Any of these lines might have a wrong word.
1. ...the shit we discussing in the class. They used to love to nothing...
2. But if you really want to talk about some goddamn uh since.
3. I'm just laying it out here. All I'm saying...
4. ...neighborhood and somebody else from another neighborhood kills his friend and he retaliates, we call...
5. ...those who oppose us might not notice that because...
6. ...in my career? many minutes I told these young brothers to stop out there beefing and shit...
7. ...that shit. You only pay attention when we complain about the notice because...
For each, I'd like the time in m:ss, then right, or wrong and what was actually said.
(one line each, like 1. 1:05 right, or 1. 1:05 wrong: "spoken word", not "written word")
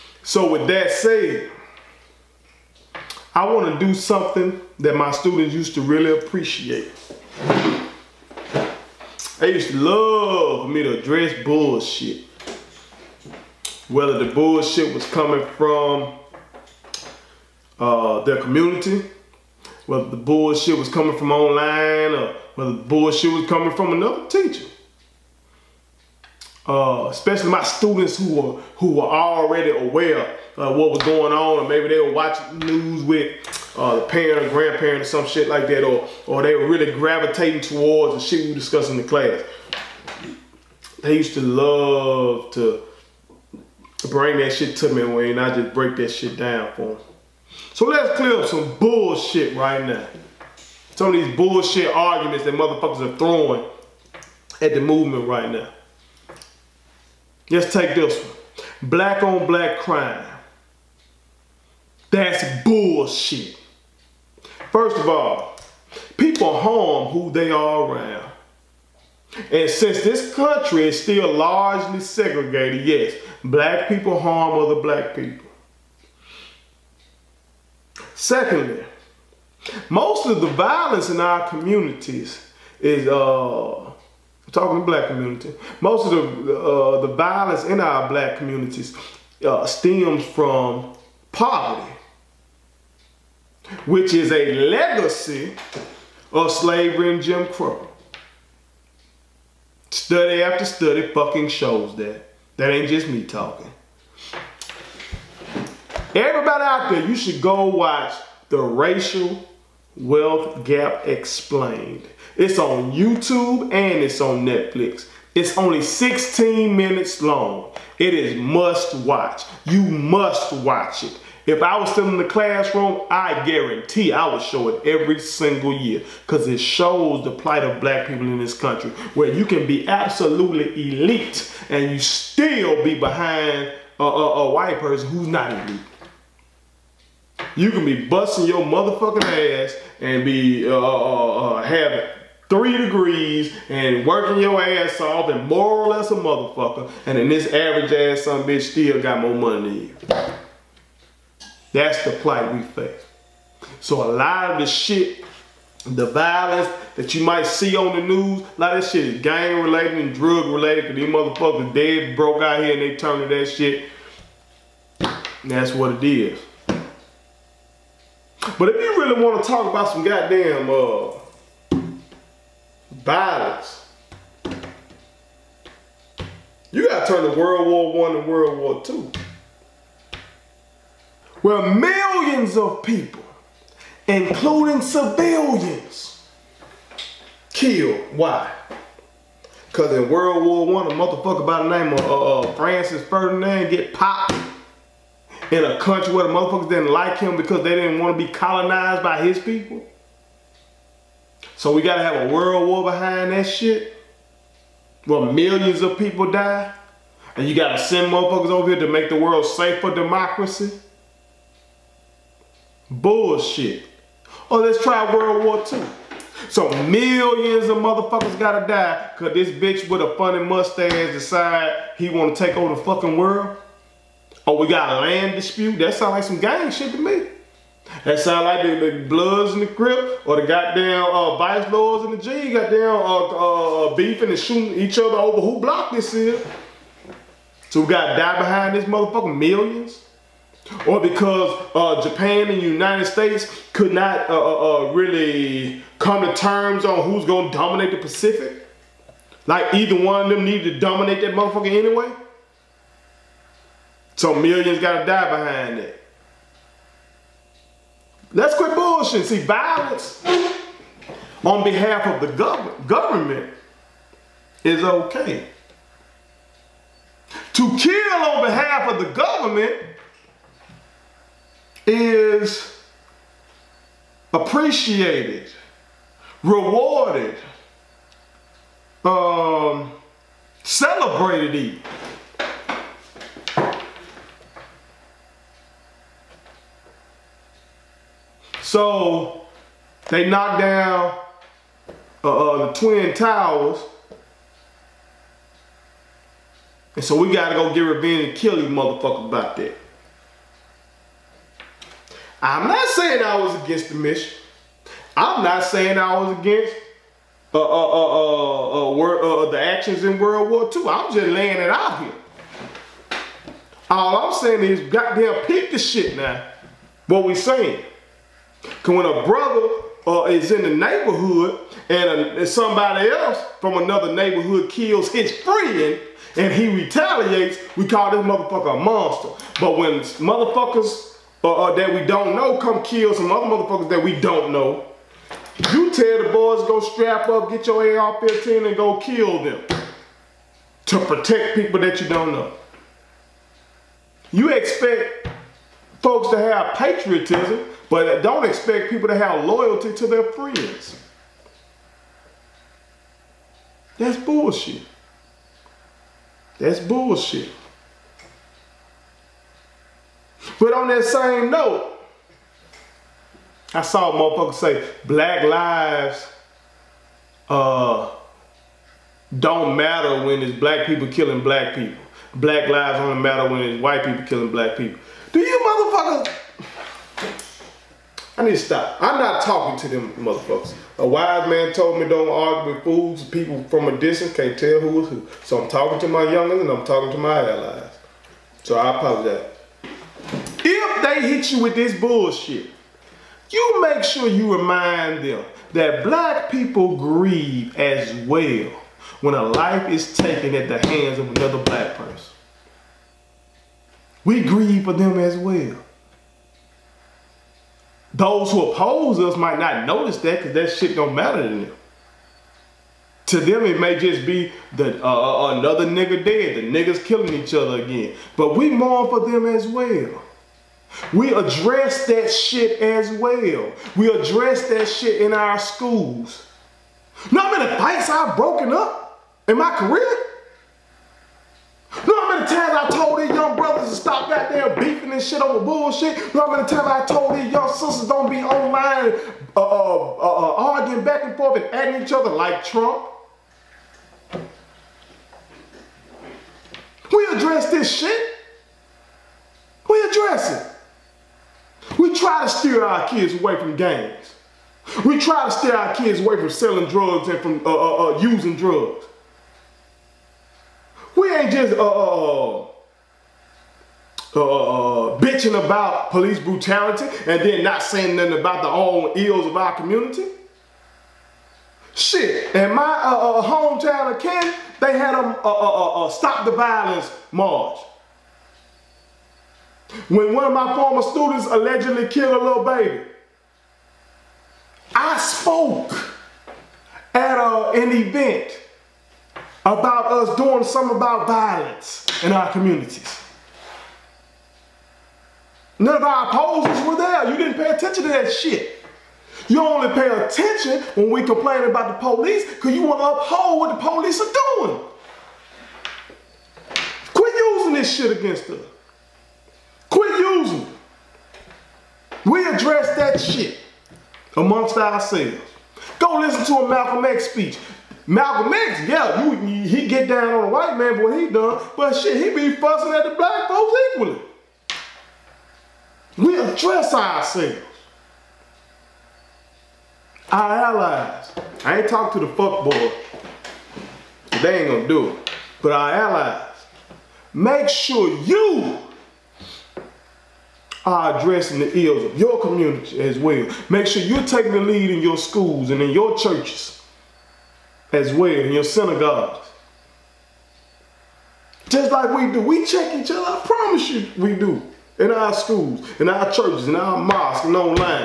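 1. 0:38 wrong: "bring", not "nothing"
2. 2:48 wrong: "violence", not "since"
3. 5:10 right
4. 5:20 right
5. 6:48 right
6. 7:09 wrong: "times", not "minutes"
7. 8:18 wrong: "police", not "notice".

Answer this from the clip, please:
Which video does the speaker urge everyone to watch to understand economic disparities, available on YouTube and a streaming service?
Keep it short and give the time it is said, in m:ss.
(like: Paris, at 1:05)
The Racial Wealth Gap Explained, at 1:48.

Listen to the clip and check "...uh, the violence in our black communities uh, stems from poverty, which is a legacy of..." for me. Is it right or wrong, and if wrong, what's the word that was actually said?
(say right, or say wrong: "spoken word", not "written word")
right.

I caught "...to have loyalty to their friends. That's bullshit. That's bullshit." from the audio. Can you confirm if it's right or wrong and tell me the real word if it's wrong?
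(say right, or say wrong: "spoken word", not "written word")
right.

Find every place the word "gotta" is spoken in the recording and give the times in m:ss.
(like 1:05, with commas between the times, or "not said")
2:56, 3:21, 3:27, 3:38, 3:57, 4:14, 4:57.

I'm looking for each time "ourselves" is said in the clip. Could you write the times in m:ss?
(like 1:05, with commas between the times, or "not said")
8:34, 8:46.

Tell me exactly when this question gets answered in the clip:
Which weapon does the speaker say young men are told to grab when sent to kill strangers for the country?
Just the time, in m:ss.
5:37.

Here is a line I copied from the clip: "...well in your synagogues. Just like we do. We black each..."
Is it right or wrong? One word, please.
wrong.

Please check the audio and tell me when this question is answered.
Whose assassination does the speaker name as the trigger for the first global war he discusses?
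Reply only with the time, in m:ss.
3:12.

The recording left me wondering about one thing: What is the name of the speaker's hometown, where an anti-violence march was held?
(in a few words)
Kent.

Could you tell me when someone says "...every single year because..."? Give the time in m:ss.
2:04.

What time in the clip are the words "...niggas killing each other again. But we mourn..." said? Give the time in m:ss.
6:56.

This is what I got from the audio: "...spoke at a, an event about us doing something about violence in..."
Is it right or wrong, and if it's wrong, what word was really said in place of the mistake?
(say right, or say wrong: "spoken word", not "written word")
right.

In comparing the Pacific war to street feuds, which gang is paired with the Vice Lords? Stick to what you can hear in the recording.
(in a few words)
the G.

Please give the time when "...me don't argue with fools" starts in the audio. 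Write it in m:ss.
6:22.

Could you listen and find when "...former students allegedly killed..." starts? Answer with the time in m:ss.
8:00.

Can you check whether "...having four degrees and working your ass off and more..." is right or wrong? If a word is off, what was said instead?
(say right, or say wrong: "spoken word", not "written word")
wrong: "three", not "four".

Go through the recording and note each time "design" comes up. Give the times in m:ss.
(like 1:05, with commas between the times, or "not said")
not said.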